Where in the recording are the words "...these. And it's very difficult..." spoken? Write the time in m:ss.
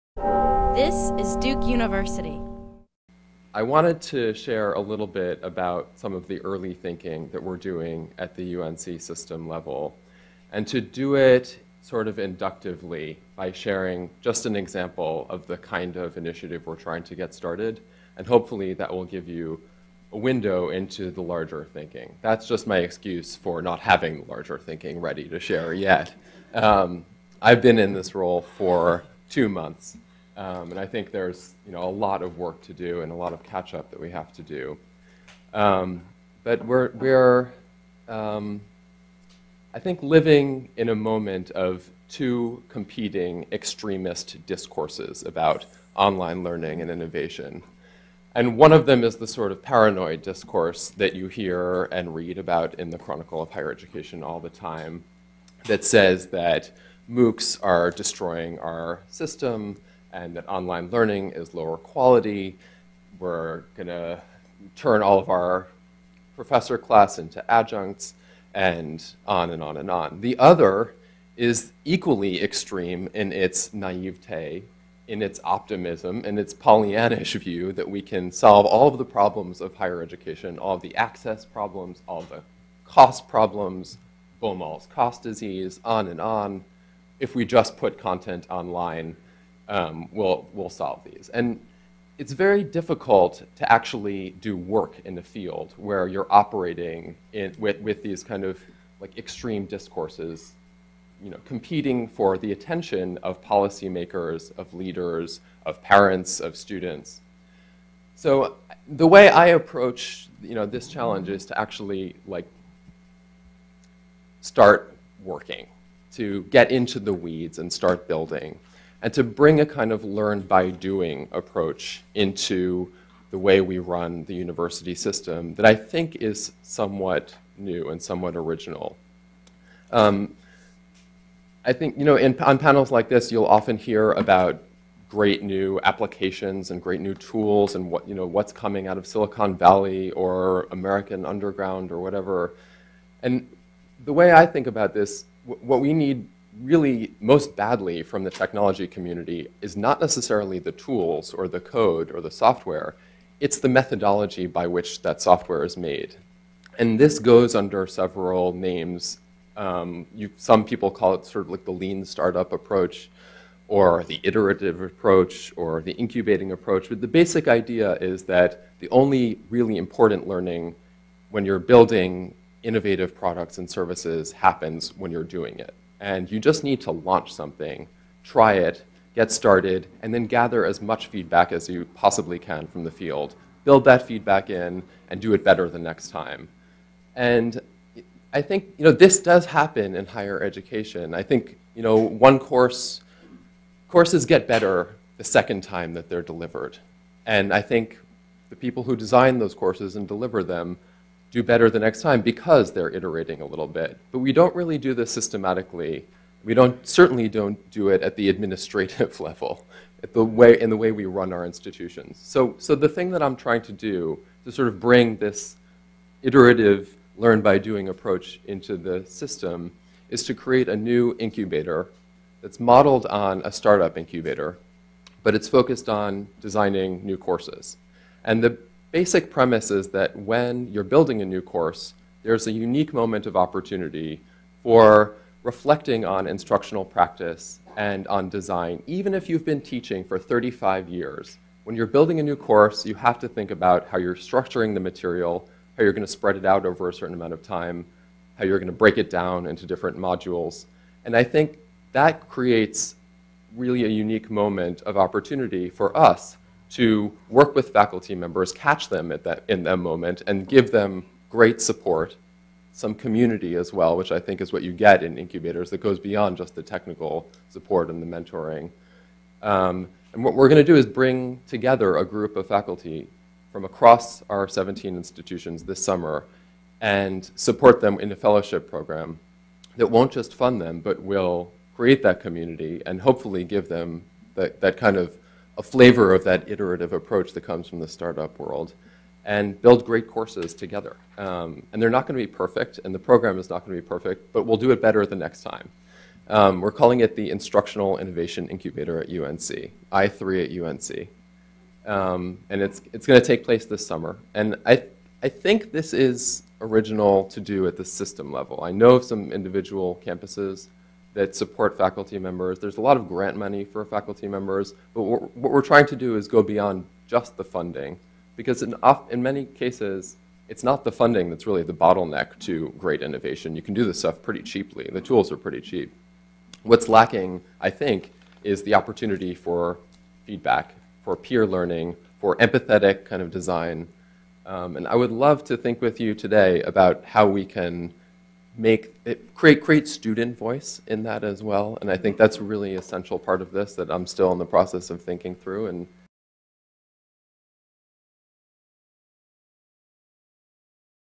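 1:31.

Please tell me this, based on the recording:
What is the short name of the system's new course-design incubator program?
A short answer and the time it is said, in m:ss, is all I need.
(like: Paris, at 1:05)
I3 at UNC, at 4:59.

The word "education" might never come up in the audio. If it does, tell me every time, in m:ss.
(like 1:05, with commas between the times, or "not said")
0:53, 1:20, 3:10.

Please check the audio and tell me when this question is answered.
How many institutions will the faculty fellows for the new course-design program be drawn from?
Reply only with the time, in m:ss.
4:34.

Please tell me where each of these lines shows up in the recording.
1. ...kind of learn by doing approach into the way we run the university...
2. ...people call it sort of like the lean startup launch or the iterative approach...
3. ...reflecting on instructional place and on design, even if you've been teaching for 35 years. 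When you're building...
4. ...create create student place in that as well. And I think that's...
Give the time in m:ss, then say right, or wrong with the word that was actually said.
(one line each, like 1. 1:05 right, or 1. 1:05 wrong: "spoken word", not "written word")
1. 1:59 right
2. 2:40 wrong: "approach", not "launch"
3. 3:55 wrong: "practice", not "place"
4. 5:39 wrong: "voice", not "place".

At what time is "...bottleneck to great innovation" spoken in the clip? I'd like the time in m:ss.
5:21.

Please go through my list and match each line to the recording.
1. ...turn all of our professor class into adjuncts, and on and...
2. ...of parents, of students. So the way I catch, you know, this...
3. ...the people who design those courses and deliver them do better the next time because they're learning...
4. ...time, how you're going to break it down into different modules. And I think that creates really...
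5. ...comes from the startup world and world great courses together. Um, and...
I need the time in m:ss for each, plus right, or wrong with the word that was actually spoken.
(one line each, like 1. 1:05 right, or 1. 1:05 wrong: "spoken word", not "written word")
1. 1:04 right
2. 1:45 wrong: "approach", not "catch"
3. 3:18 wrong: "iterating", not "learning"
4. 4:07 right
5. 4:47 wrong: "build", not "world".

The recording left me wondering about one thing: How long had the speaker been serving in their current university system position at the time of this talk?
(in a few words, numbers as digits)
2 months.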